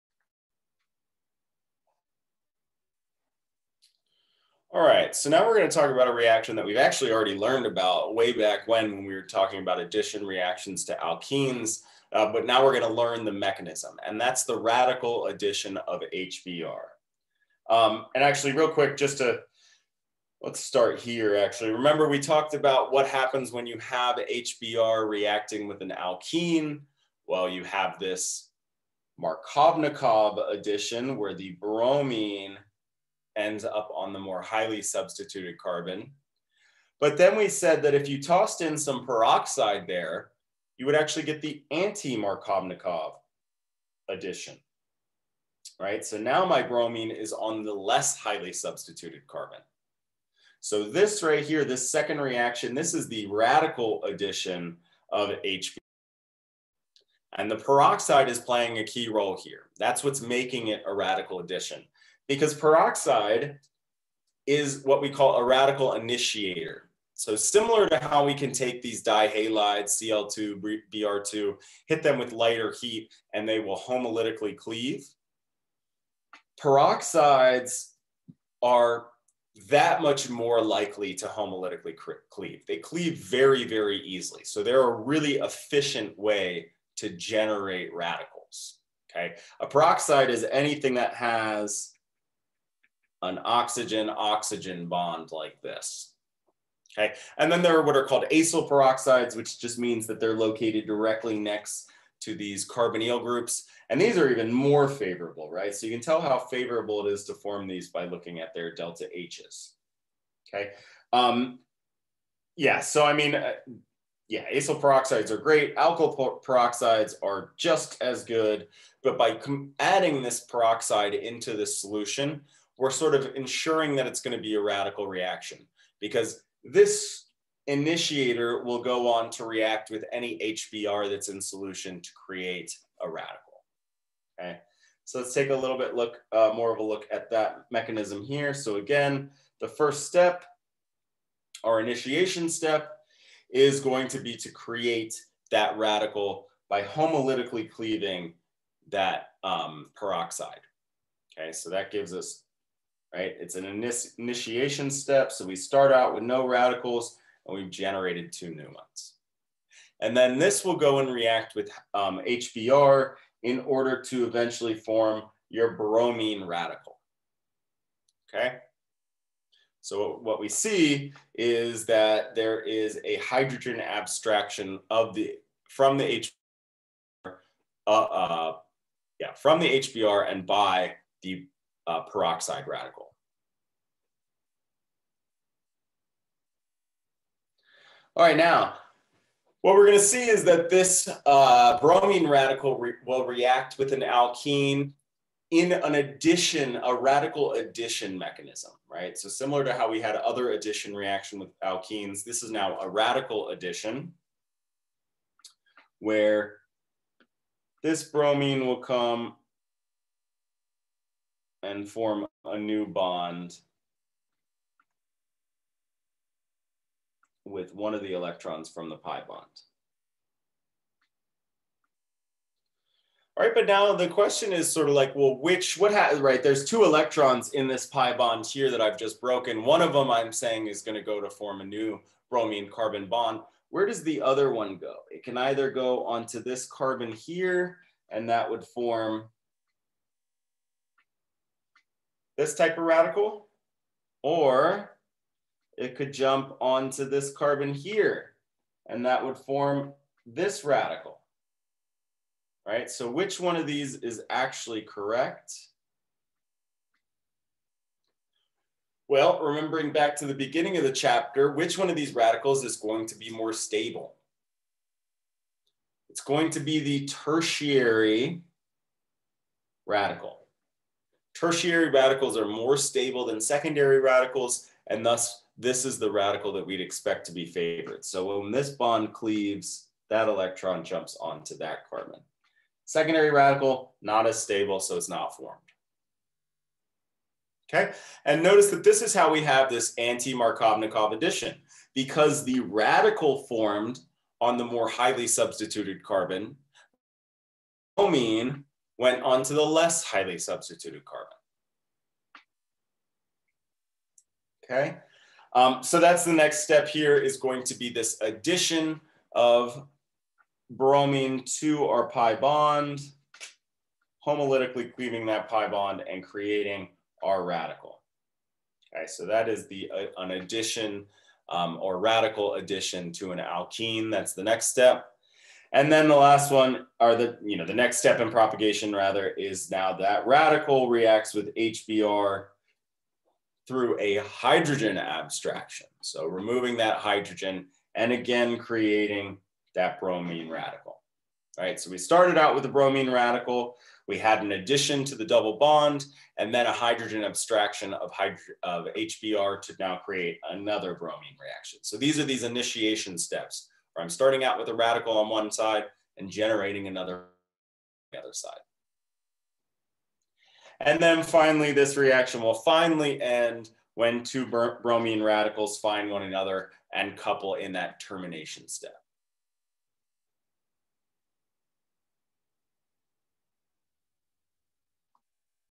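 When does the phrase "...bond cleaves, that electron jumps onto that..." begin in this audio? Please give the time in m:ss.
4:38.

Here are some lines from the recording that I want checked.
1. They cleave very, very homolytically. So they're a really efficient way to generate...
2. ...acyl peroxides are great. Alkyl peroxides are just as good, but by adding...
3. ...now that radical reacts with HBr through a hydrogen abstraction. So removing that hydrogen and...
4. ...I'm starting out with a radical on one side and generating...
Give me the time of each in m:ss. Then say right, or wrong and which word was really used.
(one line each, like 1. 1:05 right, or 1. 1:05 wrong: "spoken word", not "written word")
1. 1:22 wrong: "easily", not "homolytically"
2. 1:54 right
3. 5:29 right
4. 5:54 right.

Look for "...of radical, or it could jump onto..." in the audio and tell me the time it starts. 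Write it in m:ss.
4:02.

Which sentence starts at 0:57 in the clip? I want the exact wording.
And the peroxide is playing a key role here.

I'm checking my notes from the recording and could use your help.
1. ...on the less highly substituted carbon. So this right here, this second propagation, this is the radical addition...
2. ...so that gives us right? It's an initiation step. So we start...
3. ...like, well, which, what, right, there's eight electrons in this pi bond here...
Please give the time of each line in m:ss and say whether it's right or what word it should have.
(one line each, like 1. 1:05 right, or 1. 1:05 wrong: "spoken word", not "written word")
1. 0:47 wrong: "reaction", not "propagation"
2. 2:31 right
3. 3:44 wrong: "two", not "eight".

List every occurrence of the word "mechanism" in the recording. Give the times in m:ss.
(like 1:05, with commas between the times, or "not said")
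0:13, 2:17, 3:18.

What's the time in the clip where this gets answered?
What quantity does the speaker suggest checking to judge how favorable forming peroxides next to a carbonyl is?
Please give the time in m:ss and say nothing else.
1:48.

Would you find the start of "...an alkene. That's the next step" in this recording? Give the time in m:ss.
5:23.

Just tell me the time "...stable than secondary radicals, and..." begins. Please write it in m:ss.
4:32.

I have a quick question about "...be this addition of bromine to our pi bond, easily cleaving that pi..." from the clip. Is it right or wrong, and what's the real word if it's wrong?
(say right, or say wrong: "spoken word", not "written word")
wrong: "homolytically", not "easily".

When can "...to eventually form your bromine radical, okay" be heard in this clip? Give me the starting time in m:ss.
2:44.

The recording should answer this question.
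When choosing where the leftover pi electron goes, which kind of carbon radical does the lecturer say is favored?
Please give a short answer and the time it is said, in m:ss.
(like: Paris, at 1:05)
Tertiary radical, at 4:27.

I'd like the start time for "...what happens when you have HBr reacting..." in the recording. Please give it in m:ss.
0:22.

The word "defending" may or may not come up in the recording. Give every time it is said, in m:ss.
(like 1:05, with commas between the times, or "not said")
not said.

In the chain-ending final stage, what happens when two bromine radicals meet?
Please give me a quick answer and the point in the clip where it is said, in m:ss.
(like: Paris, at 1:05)
Couple, at 6:07.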